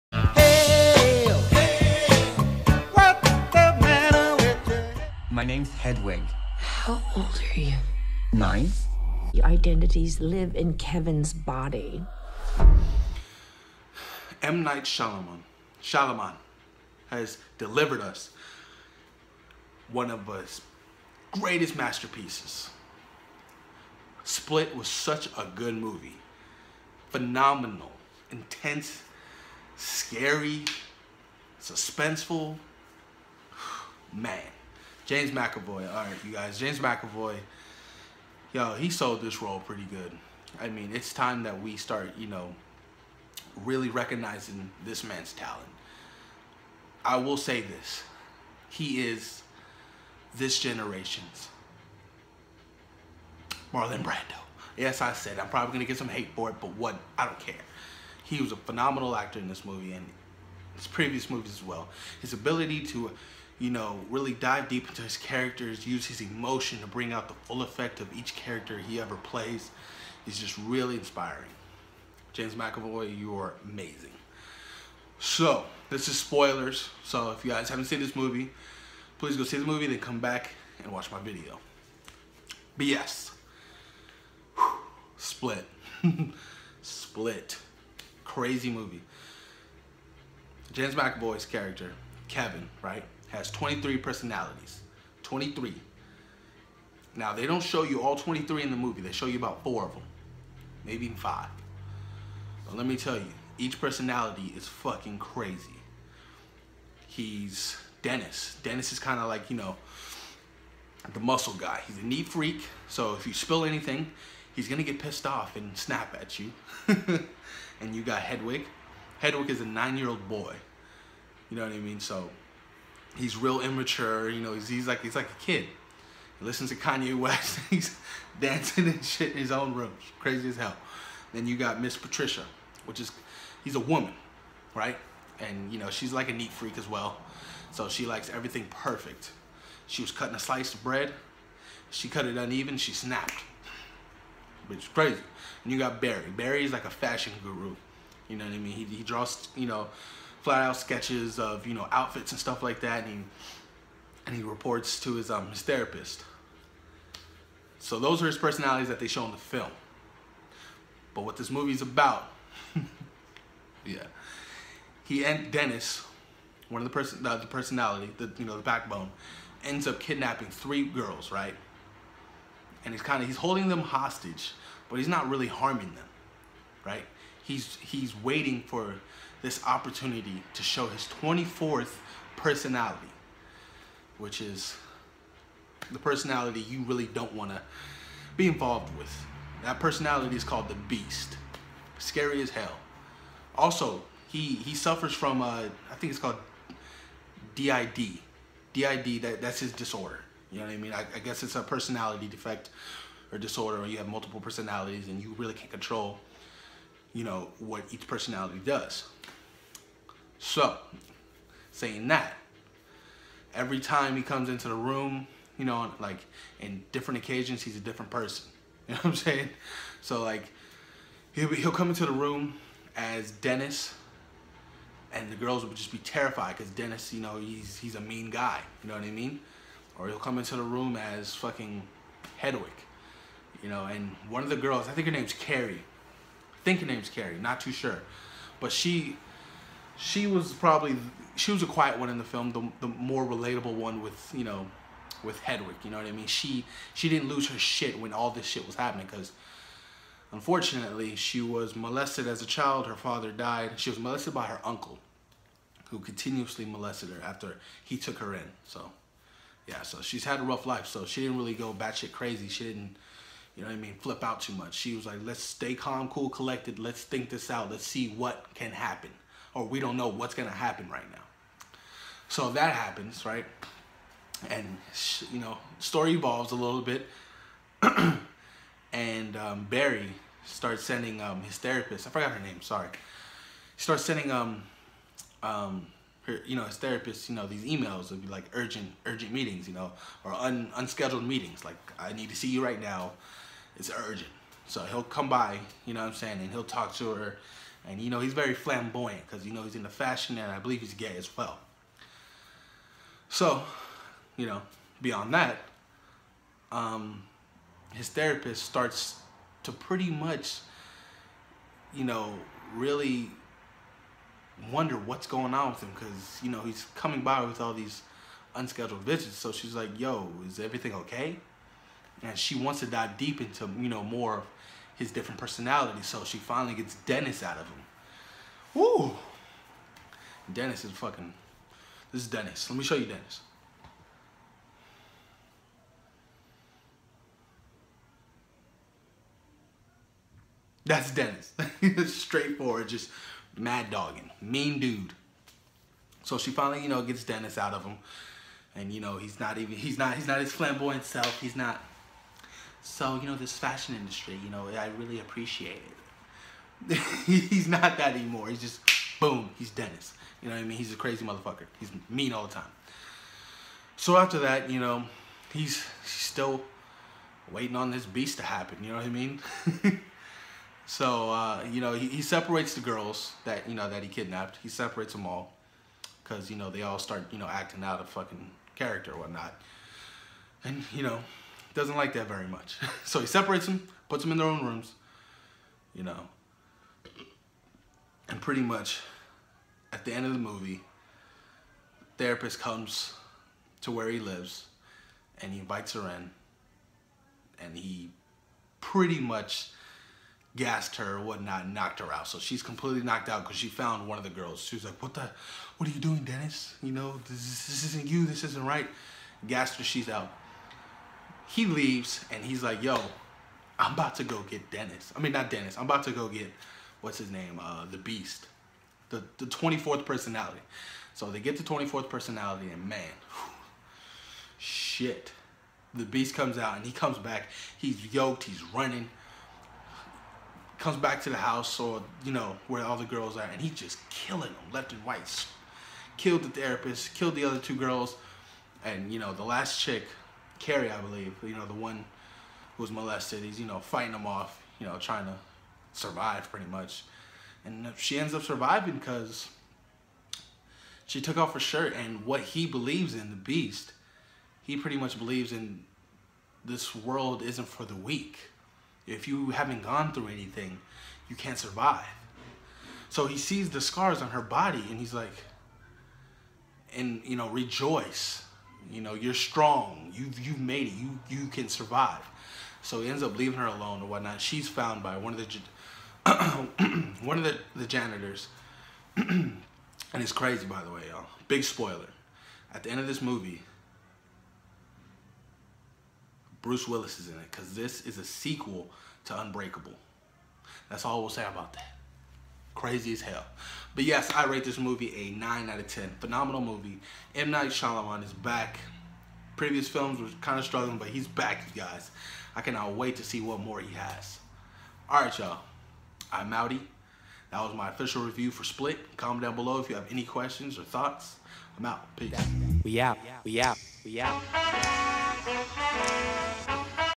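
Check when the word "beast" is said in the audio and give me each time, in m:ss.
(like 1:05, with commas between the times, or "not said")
3:10, 6:08, 6:57, 7:06, 7:33.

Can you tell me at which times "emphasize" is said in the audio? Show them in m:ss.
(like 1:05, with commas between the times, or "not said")
not said.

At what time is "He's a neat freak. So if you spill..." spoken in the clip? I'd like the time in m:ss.
1:51.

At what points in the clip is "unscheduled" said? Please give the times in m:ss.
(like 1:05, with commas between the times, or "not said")
4:50, 5:18.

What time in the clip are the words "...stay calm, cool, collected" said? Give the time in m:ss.
4:25.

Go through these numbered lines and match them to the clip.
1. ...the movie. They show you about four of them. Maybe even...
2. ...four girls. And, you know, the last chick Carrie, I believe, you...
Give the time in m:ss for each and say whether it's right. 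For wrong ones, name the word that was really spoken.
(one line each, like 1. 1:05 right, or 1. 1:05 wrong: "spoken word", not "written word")
1. 1:38 right
2. 7:17 wrong: "two", not "four".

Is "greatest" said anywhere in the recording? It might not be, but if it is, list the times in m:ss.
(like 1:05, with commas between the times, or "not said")
0:21.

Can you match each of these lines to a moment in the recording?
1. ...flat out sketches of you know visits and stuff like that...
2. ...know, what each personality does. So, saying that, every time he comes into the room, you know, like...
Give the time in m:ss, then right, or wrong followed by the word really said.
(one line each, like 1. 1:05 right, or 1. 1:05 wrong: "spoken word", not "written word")
1. 2:30 wrong: "outfits", not "visits"
2. 3:27 right.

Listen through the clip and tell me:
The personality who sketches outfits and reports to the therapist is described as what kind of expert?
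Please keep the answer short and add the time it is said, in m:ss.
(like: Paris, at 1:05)
Fashion guru, at 2:26.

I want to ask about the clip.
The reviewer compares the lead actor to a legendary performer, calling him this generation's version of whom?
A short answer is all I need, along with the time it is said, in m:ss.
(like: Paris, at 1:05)
Marlon Brando, at 0:53.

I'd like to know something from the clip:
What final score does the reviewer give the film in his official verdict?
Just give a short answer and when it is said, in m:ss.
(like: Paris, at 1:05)
9 out of 10, at 8:15.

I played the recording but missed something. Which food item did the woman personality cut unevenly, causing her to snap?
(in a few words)
A slice of bread.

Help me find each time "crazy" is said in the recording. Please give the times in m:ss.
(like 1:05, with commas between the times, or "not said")
1:28, 1:45, 2:10, 2:24, 4:22, 6:00, 8:00, 8:12.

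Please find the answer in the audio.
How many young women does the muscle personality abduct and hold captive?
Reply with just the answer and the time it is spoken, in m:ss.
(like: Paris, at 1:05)
3, at 2:50.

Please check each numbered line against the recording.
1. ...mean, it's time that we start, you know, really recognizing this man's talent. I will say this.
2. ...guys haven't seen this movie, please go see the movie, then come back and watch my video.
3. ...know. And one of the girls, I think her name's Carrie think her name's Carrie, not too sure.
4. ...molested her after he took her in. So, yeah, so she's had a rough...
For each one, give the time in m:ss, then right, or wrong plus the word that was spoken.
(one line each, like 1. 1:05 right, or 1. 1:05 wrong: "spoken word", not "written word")
1. 0:40 right
2. 1:17 right
3. 3:53 right
4. 4:16 right.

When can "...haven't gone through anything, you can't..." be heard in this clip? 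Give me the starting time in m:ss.
7:39.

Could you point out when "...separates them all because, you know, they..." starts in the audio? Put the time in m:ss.
6:14.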